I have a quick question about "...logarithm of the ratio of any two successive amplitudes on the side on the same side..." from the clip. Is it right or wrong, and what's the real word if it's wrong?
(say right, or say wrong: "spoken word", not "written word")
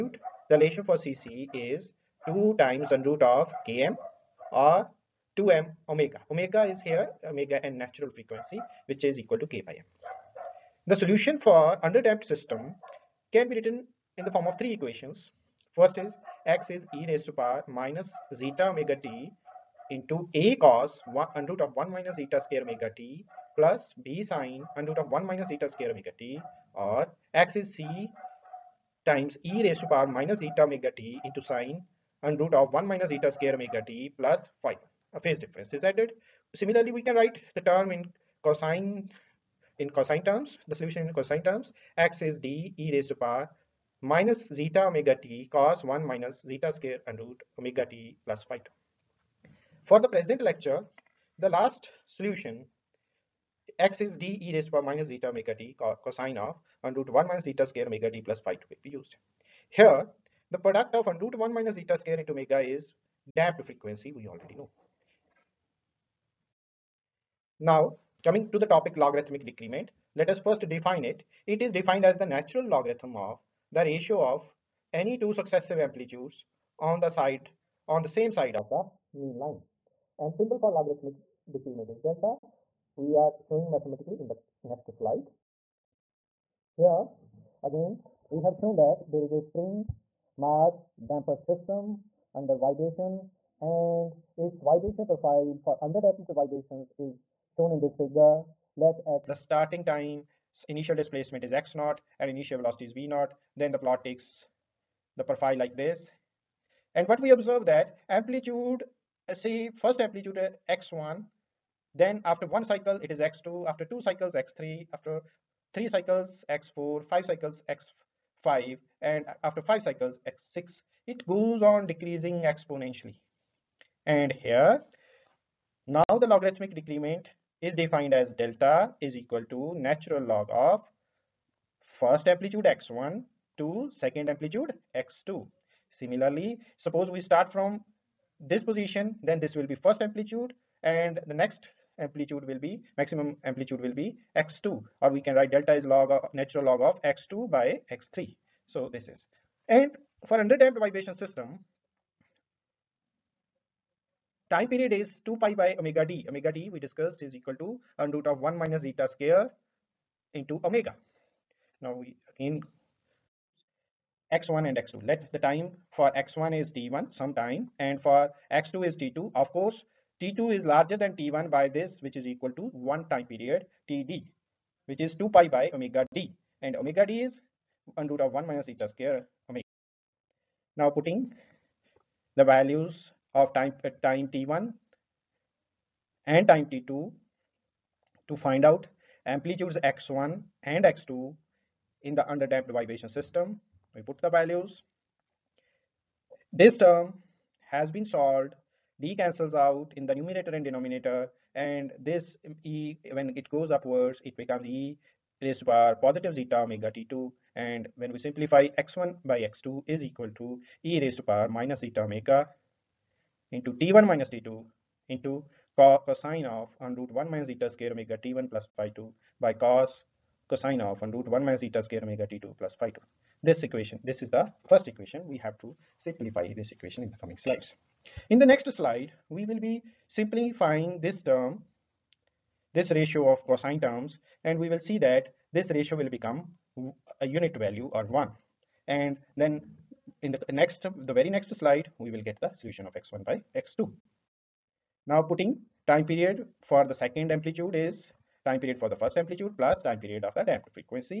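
right.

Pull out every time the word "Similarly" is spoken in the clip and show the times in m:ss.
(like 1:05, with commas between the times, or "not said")
0:36, 2:15.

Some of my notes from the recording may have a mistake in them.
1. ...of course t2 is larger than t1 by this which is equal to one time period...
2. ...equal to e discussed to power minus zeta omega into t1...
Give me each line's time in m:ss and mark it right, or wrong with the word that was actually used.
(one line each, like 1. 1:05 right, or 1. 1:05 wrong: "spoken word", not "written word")
1. 2:49 right
2. 3:30 wrong: "raised", not "discussed".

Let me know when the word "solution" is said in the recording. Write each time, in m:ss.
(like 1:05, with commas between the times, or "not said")
0:10, 0:40, 0:52, 4:02.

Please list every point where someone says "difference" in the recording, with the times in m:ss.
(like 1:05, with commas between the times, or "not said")
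0:35.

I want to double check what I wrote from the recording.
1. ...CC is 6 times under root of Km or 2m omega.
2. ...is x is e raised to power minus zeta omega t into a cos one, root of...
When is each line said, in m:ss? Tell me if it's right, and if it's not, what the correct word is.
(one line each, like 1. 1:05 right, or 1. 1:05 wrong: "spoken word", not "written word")
1. 0:00 wrong: "2", not "6"
2. 0:15 right.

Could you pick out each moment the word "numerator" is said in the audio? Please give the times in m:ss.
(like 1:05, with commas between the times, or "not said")
3:20.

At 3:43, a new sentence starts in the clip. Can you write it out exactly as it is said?
This equation, this is the first equation.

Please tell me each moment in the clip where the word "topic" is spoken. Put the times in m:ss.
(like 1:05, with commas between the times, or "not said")
1:08.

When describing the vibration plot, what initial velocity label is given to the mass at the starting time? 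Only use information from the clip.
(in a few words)
v naught.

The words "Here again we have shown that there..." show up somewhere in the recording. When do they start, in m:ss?
1:26.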